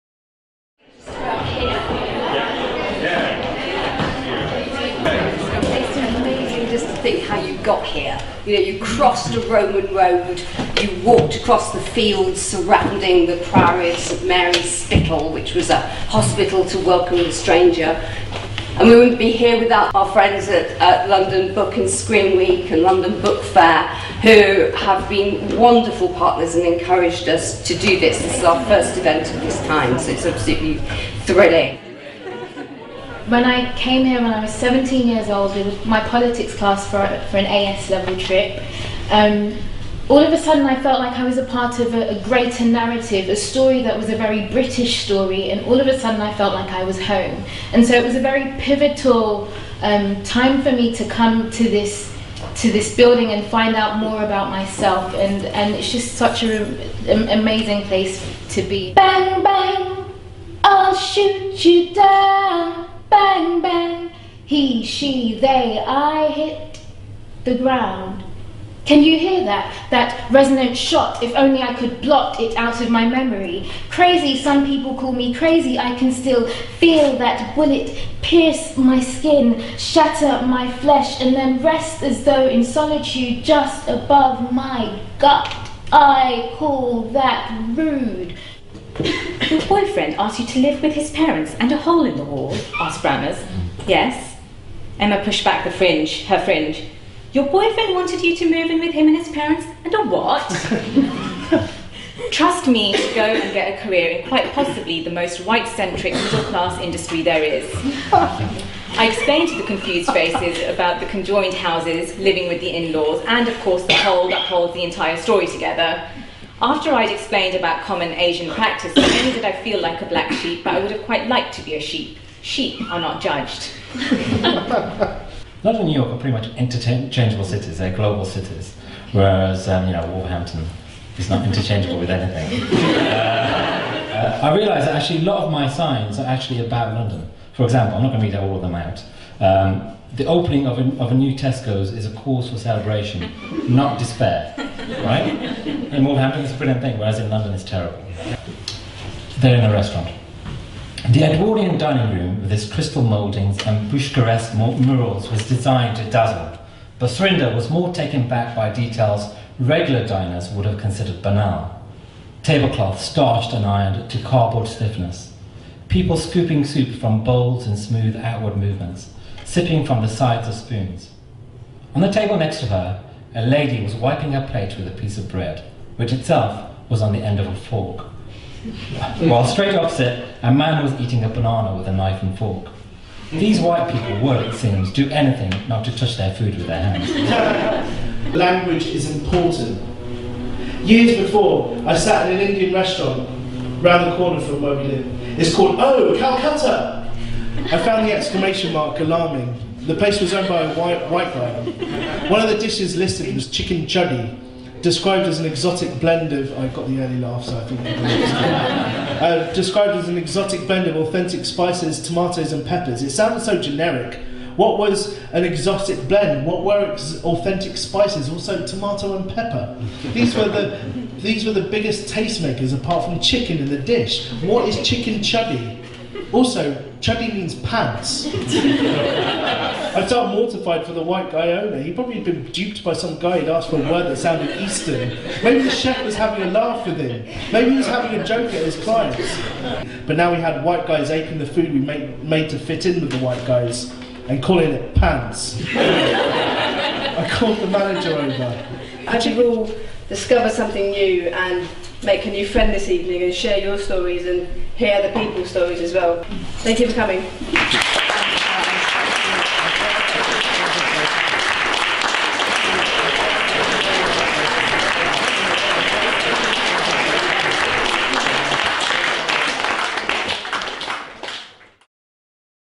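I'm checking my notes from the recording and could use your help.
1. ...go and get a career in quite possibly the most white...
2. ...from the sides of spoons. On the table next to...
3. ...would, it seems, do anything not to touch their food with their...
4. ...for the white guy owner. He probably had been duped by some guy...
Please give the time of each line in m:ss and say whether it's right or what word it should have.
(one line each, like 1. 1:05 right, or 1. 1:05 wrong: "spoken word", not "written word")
1. 1:43 right
2. 2:49 right
3. 3:04 right
4. 3:50 right.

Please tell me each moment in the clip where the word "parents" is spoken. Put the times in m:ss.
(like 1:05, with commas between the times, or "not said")
1:31, 1:39.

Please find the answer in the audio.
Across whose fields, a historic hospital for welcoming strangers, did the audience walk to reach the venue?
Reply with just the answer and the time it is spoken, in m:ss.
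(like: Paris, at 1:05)
Priory of St Mary's Spital, at 0:13.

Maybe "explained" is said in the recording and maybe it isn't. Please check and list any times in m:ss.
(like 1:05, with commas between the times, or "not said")
1:49, 1:57.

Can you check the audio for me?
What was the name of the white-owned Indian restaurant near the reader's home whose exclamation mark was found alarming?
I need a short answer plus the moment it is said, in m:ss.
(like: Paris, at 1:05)
Oh, Calcutta!, at 3:15.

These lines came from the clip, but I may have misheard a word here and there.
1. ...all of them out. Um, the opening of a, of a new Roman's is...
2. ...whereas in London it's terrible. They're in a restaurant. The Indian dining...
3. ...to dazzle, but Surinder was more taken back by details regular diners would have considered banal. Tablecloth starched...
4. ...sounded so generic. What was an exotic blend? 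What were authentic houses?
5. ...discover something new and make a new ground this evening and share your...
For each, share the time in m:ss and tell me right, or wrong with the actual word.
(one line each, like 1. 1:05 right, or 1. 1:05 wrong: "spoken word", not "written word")
1. 2:18 wrong: "Tesco", not "Roman"
2. 2:26 wrong: "Edwardian", not "Indian"
3. 2:35 right
4. 3:33 wrong: "spices", not "houses"
5. 4:10 wrong: "friend", not "ground".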